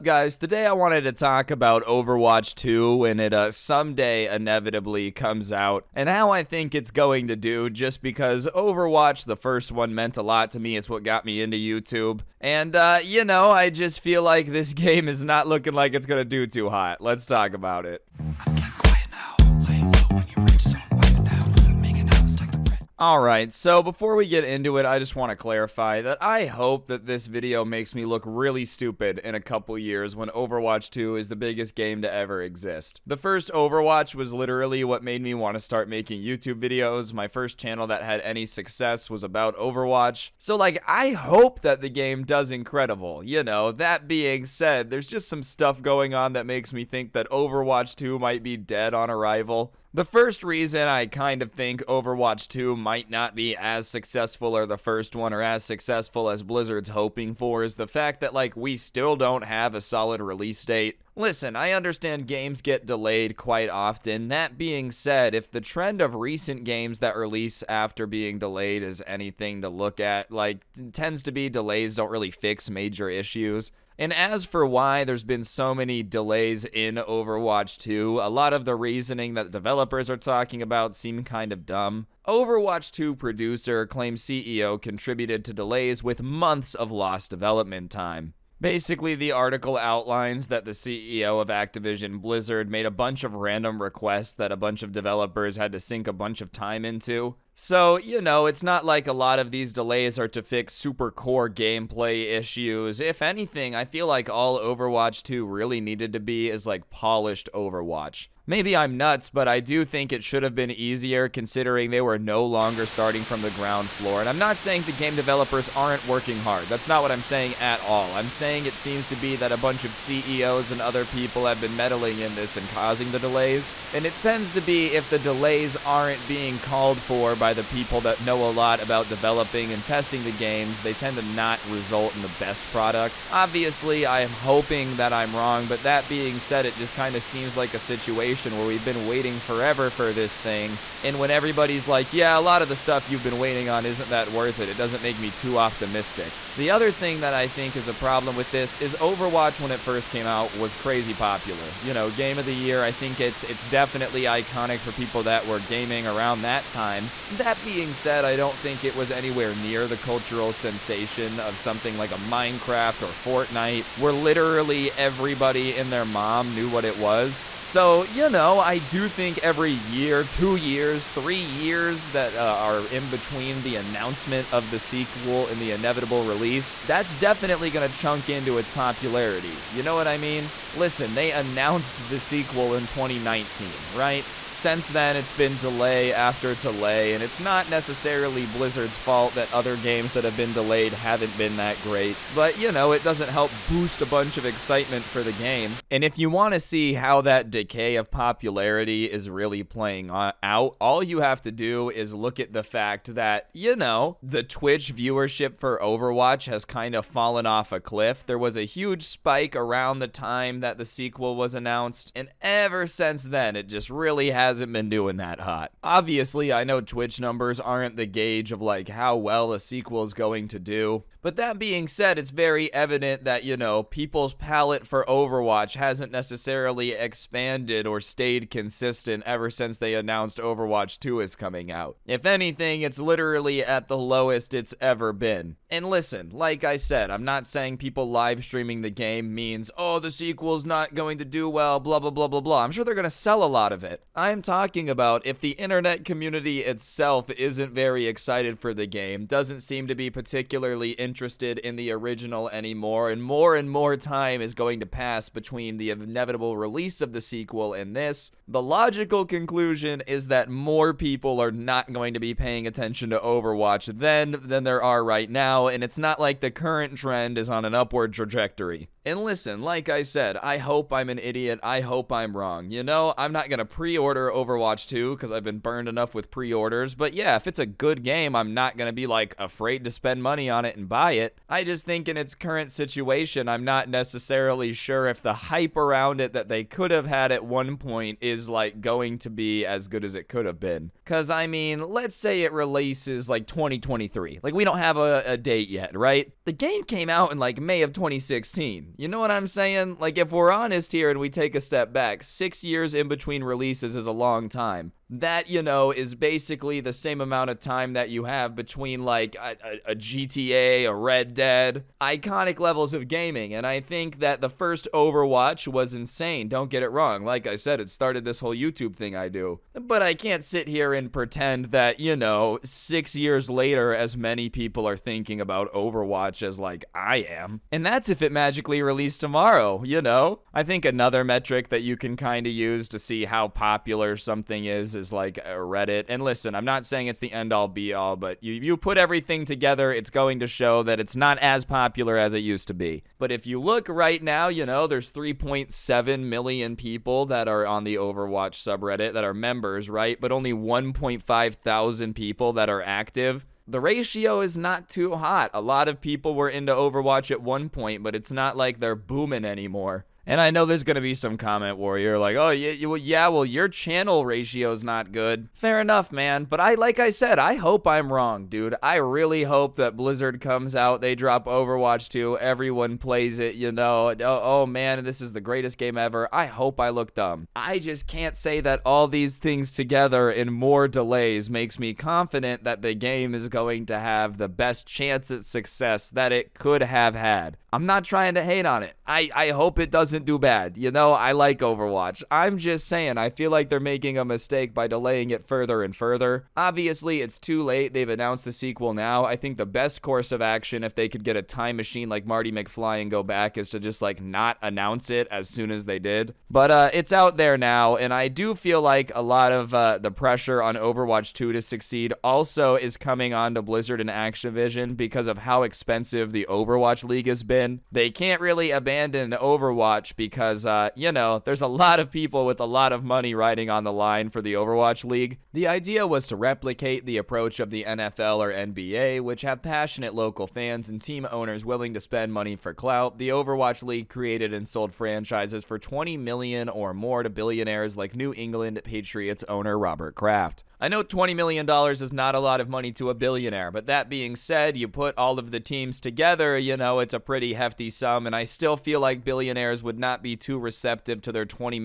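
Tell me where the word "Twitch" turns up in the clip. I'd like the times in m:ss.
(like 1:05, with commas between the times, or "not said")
3:24, 3:36.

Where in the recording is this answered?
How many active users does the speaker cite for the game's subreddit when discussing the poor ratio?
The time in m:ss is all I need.
5:50.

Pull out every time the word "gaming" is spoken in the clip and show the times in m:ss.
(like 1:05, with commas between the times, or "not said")
2:35, 5:13.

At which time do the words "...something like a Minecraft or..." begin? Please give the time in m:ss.
2:41.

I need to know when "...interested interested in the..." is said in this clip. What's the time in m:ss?
4:10.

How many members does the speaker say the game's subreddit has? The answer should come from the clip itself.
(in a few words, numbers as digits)
3.7 million.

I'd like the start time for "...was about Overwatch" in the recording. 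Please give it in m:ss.
0:39.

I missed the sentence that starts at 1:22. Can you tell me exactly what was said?
Overwatch 2 producer claims CEO contributed to delays with months of lost development time.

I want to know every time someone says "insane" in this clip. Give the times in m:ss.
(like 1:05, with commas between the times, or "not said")
5:15.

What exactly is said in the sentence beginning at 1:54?
And I'm not saying the game developers aren't working hard.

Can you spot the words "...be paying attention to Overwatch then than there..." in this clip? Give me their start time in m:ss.
4:22.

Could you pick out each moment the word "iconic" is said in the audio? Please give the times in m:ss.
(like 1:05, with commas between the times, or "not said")
2:34, 5:12.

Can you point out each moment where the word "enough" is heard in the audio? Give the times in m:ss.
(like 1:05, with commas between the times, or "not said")
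4:35, 6:05.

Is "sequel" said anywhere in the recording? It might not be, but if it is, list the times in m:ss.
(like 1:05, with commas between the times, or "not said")
2:54, 3:02, 3:30, 3:39, 4:00, 4:17, 6:38.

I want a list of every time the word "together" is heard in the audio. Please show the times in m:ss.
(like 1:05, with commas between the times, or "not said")
5:39, 6:19, 7:25.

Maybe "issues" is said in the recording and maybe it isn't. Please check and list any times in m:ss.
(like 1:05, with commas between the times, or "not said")
1:13, 1:42.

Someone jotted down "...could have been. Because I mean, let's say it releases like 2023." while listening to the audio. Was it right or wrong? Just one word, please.
right.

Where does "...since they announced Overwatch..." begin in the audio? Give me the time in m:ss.
3:49.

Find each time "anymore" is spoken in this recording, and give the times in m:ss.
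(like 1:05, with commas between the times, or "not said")
4:12, 5:59.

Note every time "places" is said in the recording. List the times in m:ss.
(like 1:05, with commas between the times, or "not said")
5:35.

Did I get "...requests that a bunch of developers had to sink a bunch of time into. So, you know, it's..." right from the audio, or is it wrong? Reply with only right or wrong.
right.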